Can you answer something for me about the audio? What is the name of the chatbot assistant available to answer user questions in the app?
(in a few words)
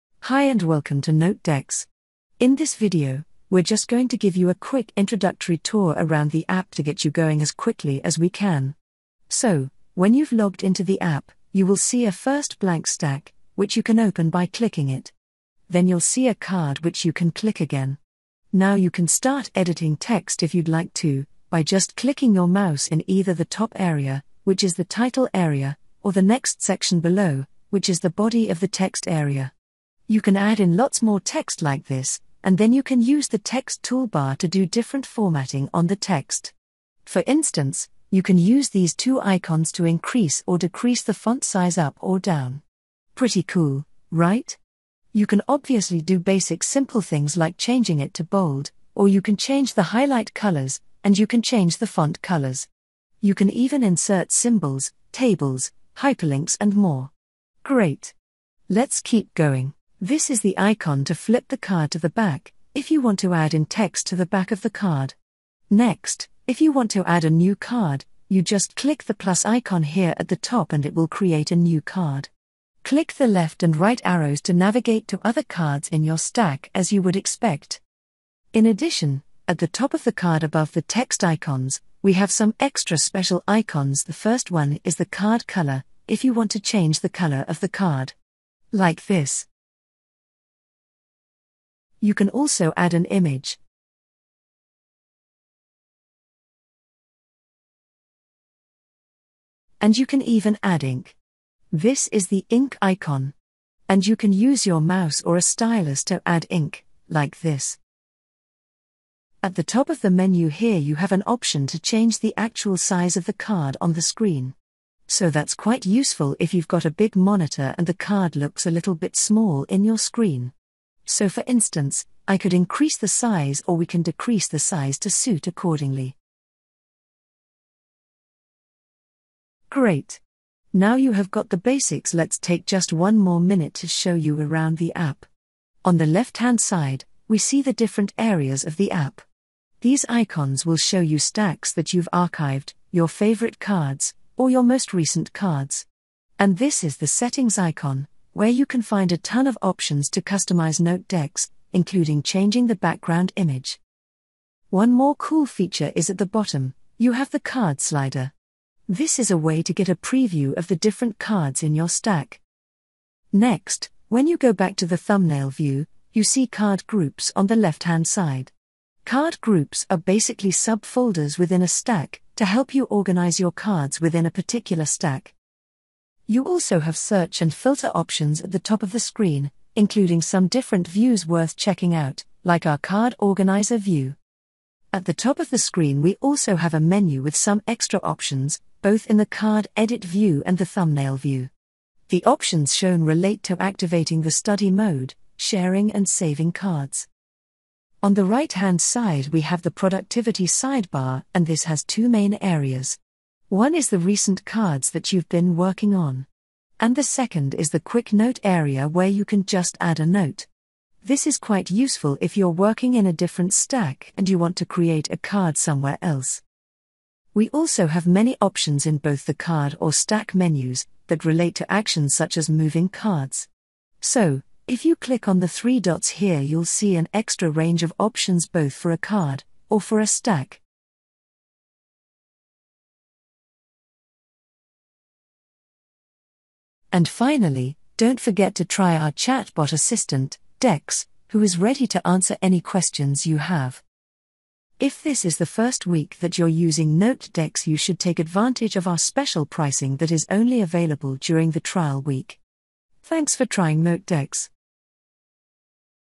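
Dex.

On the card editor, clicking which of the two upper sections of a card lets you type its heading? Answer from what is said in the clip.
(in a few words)
Title area.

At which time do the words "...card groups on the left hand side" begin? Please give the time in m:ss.
2:46.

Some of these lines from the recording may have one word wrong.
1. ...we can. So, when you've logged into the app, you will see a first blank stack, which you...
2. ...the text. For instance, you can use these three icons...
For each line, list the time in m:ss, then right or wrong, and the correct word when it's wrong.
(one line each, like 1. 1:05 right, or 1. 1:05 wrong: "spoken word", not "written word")
1. 0:08 right
2. 0:35 wrong: "two", not "three".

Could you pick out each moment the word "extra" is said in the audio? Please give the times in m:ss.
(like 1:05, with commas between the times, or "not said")
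1:22, 3:07, 3:47.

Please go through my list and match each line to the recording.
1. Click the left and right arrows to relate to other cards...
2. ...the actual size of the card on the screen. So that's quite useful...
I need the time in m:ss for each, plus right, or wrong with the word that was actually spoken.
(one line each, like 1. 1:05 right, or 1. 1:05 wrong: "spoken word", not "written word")
1. 1:12 wrong: "navigate", not "relate"
2. 1:52 right.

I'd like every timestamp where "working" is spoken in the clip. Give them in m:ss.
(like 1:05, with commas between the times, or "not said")
3:25, 3:32.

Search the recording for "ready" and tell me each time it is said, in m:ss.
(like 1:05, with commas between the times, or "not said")
4:01.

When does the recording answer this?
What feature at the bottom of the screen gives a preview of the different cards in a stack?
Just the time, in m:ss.
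2:37.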